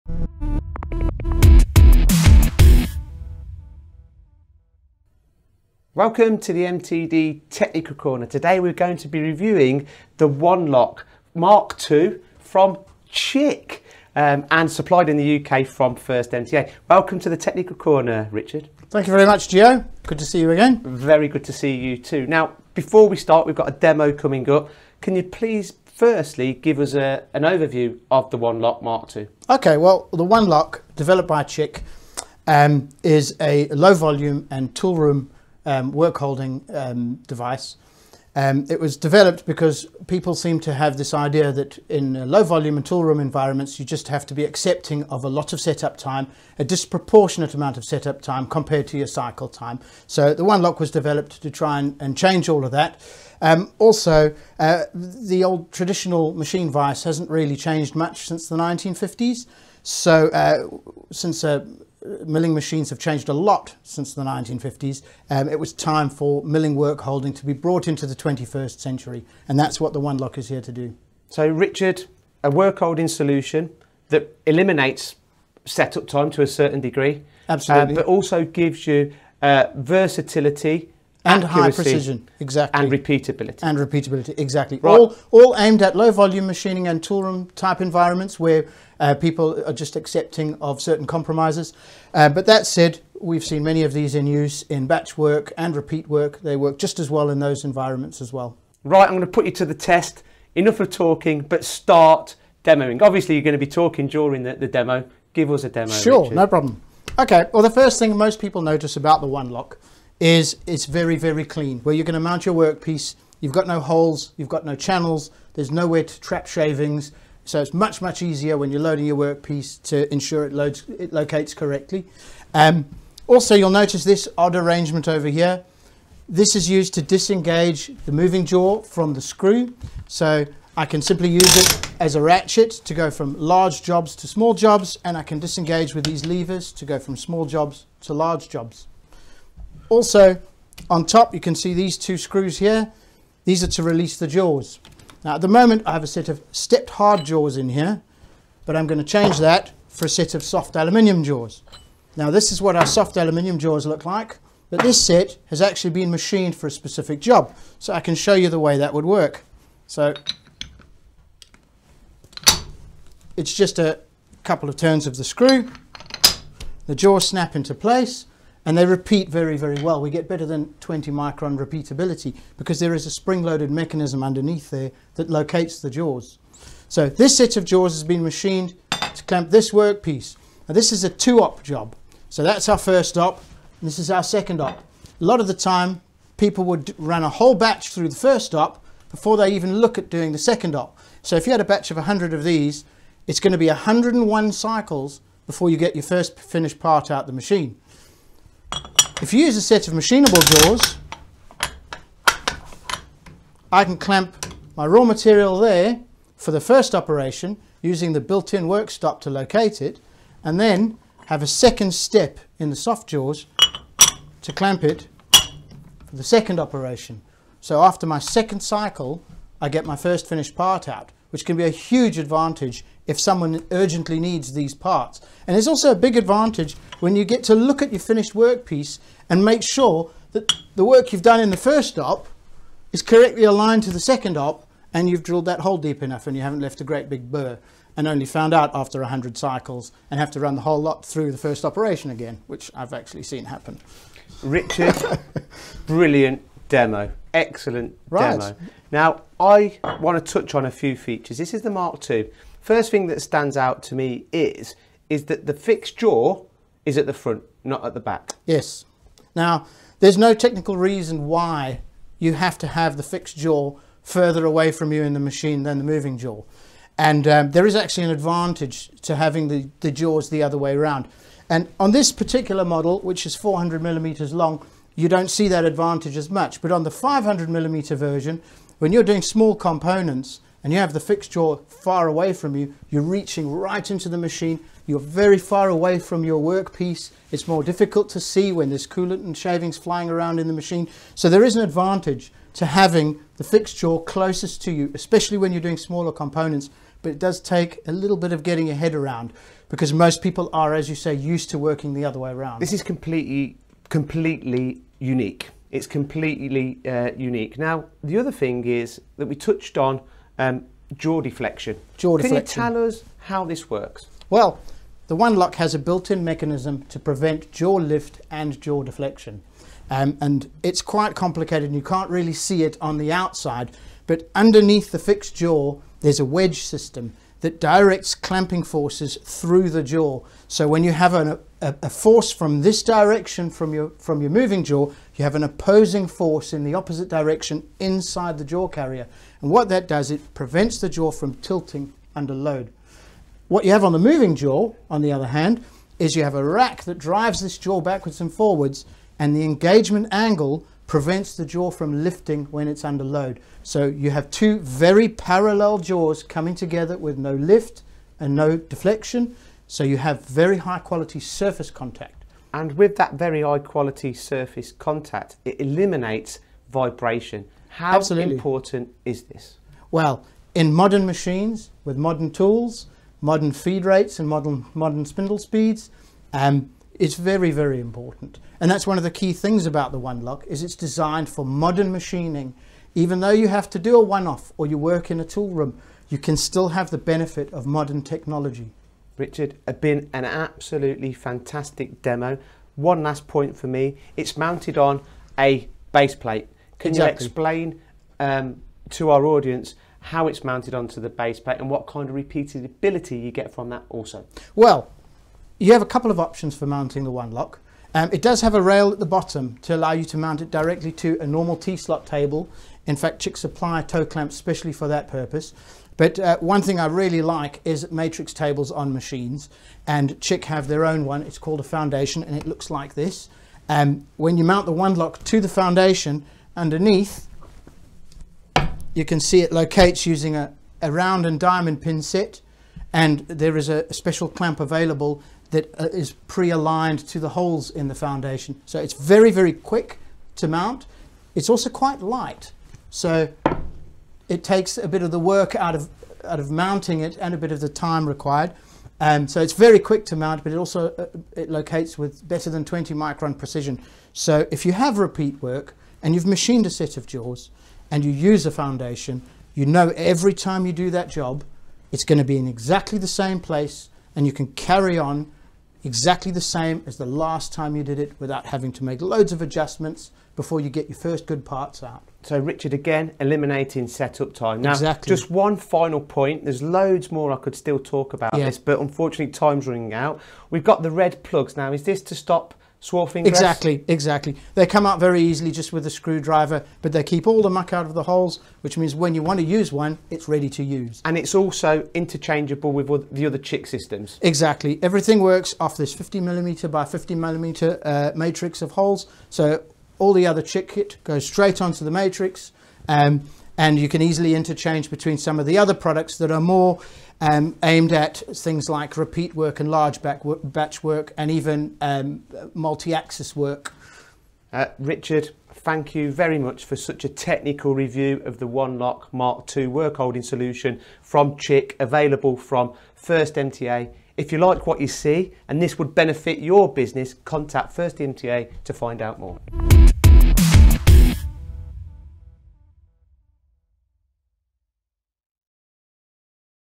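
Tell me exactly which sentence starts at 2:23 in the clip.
These are to release the jaws.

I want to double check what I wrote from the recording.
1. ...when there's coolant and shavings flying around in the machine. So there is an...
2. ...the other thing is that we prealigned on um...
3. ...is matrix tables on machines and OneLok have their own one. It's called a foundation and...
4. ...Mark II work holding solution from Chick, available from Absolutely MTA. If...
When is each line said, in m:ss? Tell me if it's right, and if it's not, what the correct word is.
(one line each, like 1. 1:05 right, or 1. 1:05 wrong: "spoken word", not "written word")
1. 4:48 right
2. 5:08 wrong: "touched", not "prealigned"
3. 6:57 wrong: "Chick", not "OneLok"
4. 8:39 wrong: "First", not "Absolutely".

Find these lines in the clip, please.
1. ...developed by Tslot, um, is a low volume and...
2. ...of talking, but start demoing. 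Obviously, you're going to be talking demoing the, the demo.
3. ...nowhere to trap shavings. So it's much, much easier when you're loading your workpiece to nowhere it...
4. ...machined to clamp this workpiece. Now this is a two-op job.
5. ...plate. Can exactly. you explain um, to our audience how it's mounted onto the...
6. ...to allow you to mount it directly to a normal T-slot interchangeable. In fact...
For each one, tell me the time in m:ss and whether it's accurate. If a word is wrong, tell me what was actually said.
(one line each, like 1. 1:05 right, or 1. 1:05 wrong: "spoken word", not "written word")
1. 0:30 wrong: "Chick", not "Tslot"
2. 1:40 wrong: "during", not "demoing"
3. 1:55 wrong: "ensure", not "nowhere"
4. 2:58 right
5. 6:36 right
6. 6:49 wrong: "table", not "interchangeable".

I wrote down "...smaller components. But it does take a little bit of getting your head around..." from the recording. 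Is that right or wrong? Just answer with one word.
right.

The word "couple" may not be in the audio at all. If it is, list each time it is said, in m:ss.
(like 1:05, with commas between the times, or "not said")
2:44, 6:45.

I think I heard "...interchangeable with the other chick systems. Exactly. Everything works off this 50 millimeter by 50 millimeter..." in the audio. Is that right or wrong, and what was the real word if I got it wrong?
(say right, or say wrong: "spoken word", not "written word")
right.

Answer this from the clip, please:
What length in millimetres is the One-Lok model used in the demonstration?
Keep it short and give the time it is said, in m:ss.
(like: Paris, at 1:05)
400 mm, at 4:33.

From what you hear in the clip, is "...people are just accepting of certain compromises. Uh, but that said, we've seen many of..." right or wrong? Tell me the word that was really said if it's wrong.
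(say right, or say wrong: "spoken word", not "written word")
right.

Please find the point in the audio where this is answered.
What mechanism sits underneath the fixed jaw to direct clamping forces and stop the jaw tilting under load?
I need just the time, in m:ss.
5:26.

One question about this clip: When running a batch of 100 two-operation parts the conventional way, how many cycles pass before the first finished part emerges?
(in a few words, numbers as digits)
101.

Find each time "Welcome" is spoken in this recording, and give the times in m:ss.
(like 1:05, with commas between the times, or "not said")
0:06, 0:16.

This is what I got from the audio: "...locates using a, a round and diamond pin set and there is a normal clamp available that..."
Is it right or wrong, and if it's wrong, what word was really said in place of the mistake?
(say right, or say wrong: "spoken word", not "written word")
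wrong: "special", not "normal".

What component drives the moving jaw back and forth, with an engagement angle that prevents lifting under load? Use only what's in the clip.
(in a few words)
A rack.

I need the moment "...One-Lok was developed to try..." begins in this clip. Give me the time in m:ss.
0:50.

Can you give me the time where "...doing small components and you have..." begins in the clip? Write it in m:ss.
4:39.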